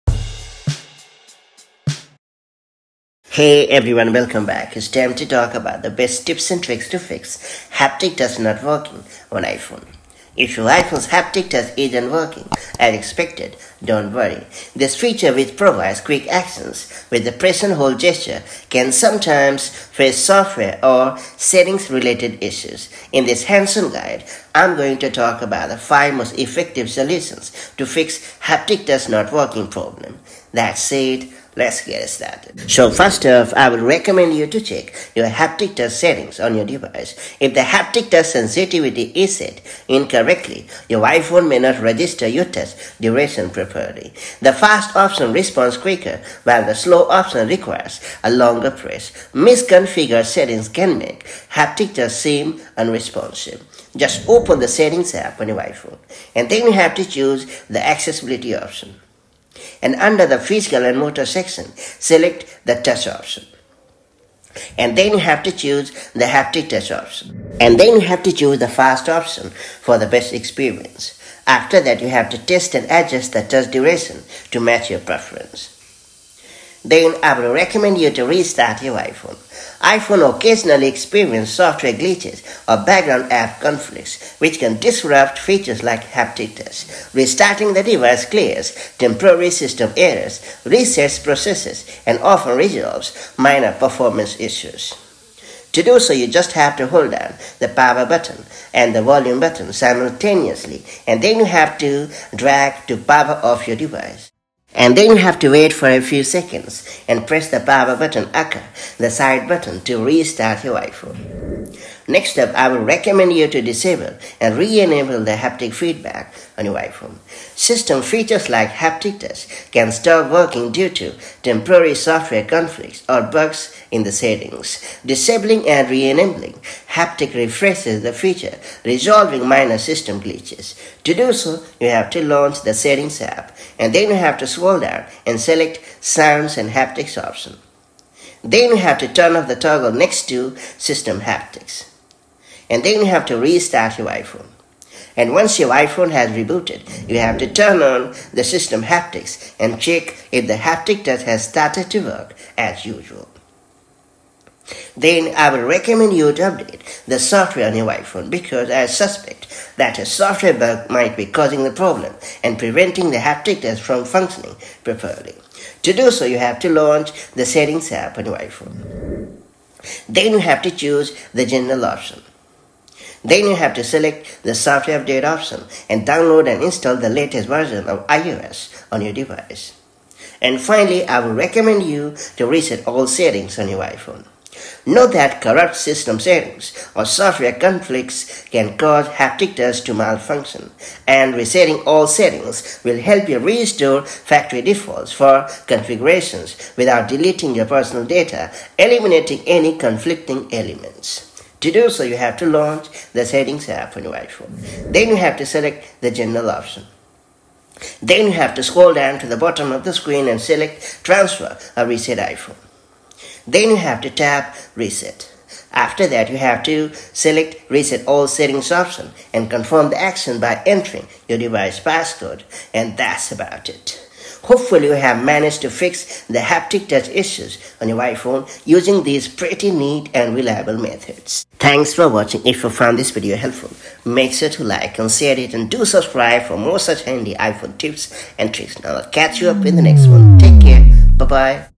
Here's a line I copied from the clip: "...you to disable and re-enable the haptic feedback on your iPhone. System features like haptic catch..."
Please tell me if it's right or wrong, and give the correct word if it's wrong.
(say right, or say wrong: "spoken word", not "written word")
wrong: "touch", not "catch".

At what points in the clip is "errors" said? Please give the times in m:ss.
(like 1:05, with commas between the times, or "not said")
1:29.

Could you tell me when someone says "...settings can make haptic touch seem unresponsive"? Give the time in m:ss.
0:50.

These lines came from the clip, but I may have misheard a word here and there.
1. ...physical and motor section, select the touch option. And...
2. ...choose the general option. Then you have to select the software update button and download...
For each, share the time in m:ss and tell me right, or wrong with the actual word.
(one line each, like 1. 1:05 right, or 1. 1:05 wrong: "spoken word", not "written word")
1. 1:00 right
2. 2:50 wrong: "option", not "button".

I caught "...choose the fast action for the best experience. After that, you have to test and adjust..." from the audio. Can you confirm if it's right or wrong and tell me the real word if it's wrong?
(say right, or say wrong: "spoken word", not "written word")
wrong: "option", not "action".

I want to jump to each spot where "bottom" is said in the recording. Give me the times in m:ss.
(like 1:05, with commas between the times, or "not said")
3:29.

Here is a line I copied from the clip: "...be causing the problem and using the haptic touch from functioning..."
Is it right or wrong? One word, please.
wrong.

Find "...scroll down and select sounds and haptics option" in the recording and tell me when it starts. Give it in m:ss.
2:14.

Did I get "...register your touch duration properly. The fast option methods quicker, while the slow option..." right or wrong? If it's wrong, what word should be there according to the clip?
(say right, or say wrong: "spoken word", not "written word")
wrong: "responds", not "methods".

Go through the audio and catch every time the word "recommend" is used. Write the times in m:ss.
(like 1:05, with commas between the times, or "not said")
0:33, 1:17, 1:52, 2:35, 3:01.